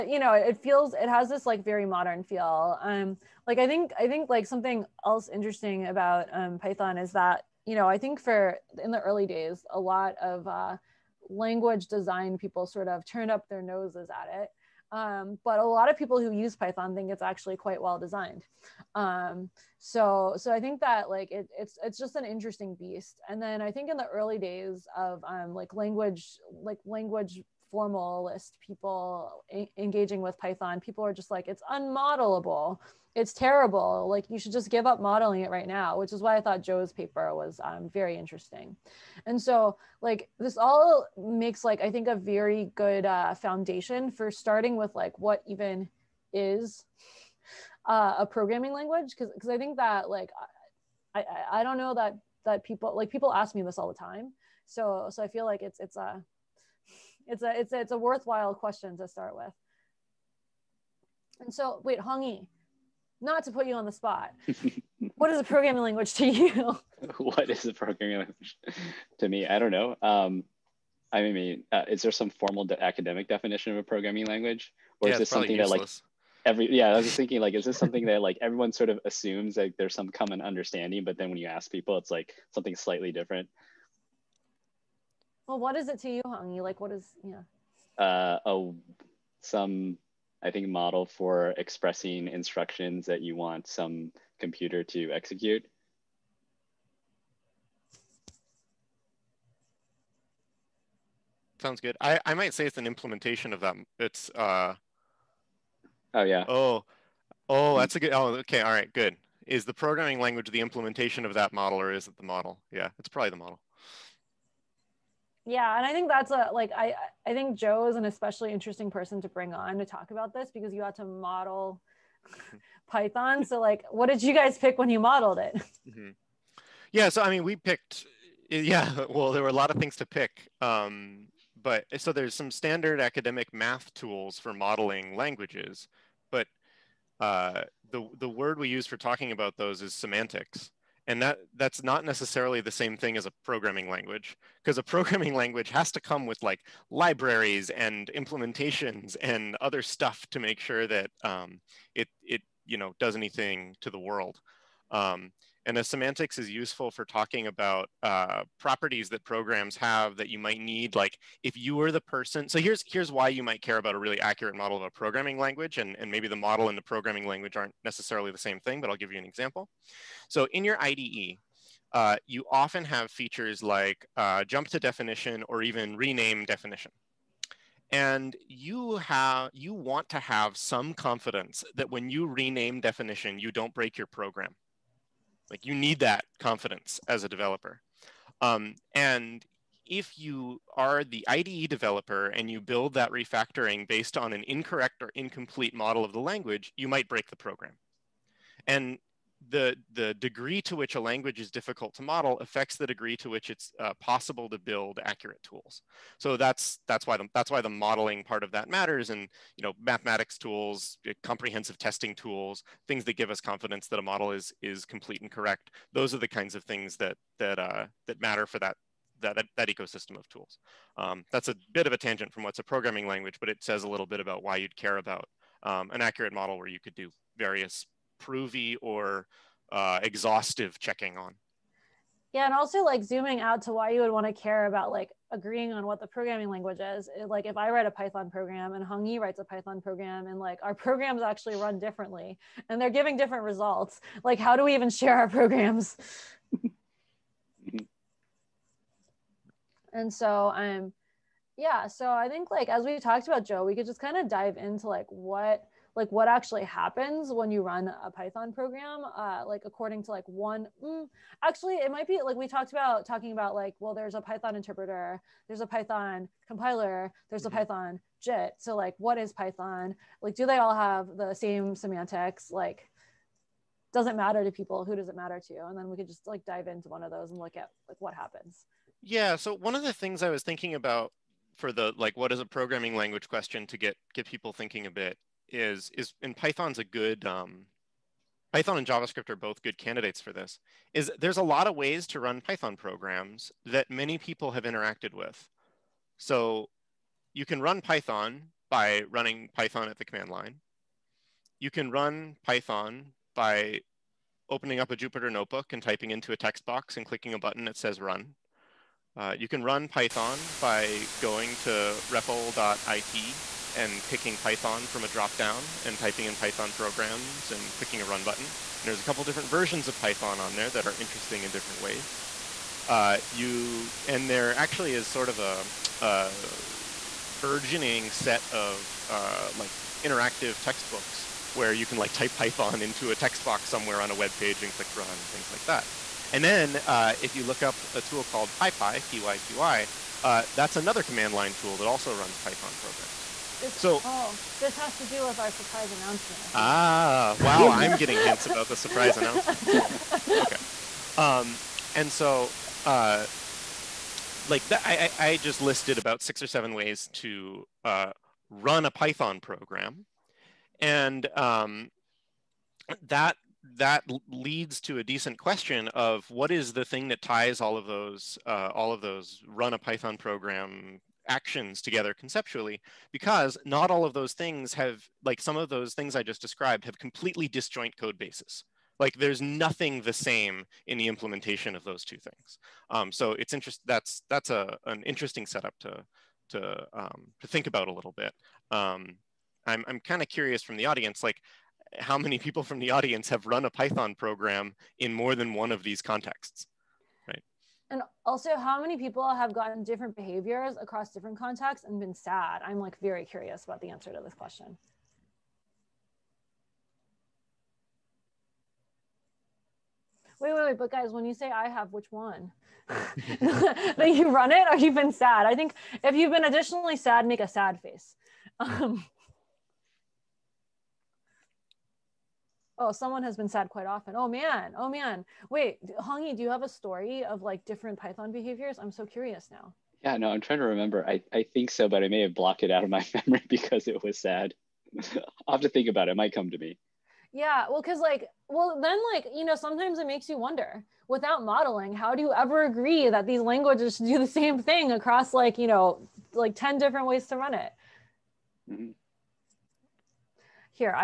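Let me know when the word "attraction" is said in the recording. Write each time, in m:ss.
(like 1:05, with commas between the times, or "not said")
not said.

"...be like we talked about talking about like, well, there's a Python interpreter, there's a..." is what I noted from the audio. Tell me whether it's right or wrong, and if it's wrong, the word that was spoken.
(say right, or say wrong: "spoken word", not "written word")
right.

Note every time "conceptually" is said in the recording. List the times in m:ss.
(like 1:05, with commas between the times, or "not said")
6:12.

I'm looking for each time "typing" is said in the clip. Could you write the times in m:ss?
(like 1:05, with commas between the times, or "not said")
5:05, 5:15.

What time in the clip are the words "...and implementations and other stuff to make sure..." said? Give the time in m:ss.
2:27.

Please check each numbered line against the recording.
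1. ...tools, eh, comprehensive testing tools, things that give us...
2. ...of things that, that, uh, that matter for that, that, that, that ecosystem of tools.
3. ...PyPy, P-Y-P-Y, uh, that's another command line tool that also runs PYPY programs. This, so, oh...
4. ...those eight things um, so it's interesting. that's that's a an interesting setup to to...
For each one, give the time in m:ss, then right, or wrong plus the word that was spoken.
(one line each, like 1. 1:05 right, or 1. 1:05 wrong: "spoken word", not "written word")
1. 3:30 right
2. 3:36 right
3. 5:38 wrong: "Python", not "PYPY"
4. 6:21 wrong: "two", not "eight".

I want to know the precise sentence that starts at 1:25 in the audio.
Well, what is it to you, Hong?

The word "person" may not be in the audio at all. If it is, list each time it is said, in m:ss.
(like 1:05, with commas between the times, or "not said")
1:58, 2:41.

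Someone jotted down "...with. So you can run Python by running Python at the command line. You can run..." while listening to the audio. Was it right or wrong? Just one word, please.
right.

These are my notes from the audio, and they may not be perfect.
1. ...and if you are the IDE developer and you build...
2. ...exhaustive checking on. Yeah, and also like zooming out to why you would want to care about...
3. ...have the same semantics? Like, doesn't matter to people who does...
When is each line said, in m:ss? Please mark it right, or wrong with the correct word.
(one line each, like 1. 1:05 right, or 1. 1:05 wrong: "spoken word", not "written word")
1. 3:08 right
2. 3:50 right
3. 4:30 right.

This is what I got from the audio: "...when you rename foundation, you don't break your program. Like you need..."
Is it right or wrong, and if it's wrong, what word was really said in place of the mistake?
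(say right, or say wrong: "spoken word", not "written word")
wrong: "definition", not "foundation".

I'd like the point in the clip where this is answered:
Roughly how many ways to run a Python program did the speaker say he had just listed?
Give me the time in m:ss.
5:56.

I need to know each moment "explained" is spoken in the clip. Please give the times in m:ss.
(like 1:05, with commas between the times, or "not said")
not said.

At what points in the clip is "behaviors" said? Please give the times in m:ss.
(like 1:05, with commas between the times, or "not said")
6:40, 7:08.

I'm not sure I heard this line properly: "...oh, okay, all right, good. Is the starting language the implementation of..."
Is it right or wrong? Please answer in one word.
wrong.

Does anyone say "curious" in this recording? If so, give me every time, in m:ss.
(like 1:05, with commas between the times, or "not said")
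6:30, 6:43, 7:09.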